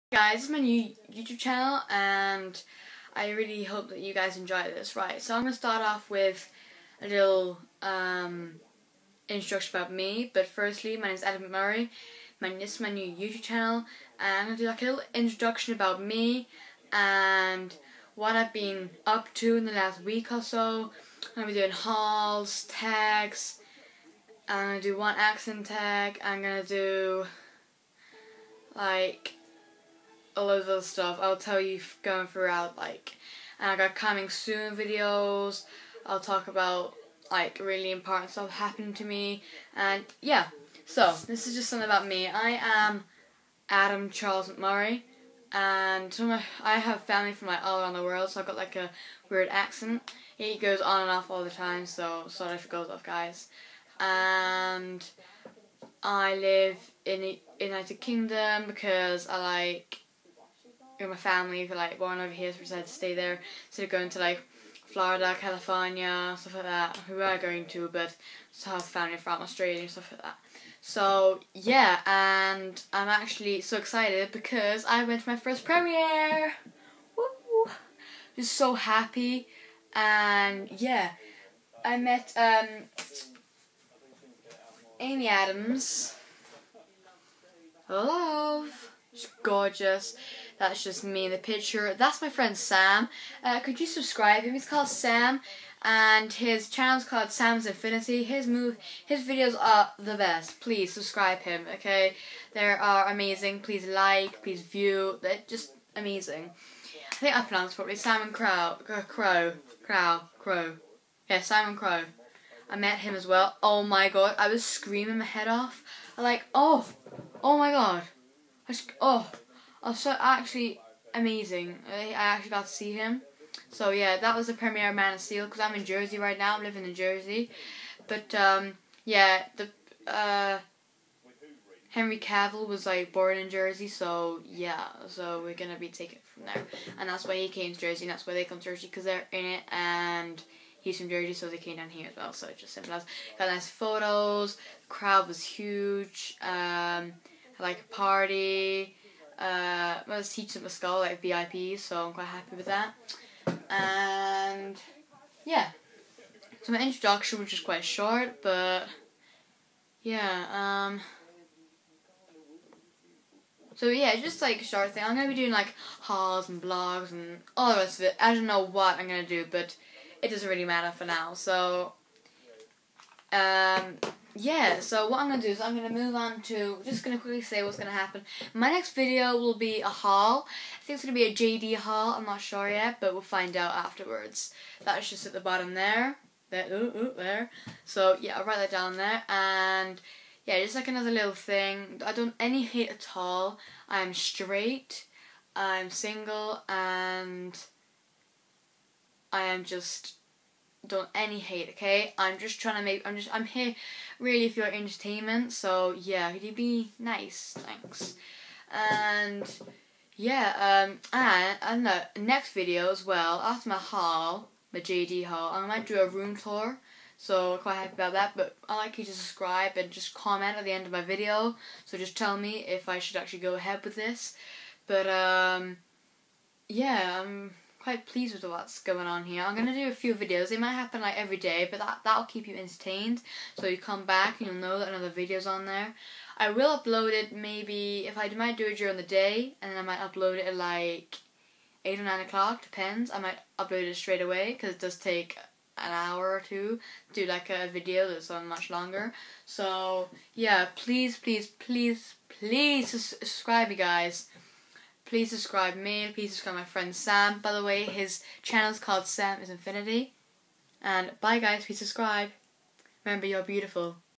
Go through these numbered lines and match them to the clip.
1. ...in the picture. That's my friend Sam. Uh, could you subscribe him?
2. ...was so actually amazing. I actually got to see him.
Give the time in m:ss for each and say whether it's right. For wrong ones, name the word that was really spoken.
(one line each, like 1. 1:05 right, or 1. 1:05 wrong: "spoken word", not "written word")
1. 1:31 right
2. 1:59 right.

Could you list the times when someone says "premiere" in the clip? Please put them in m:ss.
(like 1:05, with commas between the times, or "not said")
1:15, 2:04.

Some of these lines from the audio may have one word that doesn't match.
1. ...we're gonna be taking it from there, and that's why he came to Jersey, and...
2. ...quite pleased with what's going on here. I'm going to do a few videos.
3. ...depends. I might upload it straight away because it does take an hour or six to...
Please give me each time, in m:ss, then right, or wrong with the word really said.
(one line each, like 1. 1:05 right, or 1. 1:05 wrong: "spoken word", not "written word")
1. 2:15 right
2. 3:47 right
3. 4:02 wrong: "two", not "six".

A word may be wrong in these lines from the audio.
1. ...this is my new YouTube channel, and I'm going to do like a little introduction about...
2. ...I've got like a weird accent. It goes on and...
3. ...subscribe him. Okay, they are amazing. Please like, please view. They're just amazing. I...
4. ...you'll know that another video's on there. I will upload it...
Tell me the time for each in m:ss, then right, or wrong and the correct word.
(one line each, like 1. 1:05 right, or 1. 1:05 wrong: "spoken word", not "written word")
1. 0:12 right
2. 0:48 right
3. 1:40 right
4. 3:54 right.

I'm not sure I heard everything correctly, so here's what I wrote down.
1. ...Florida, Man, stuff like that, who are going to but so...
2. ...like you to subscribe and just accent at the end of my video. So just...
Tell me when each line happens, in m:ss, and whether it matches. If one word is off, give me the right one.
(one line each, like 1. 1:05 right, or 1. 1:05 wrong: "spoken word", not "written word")
1. 1:04 wrong: "California", not "Man"
2. 3:38 wrong: "comment", not "accent".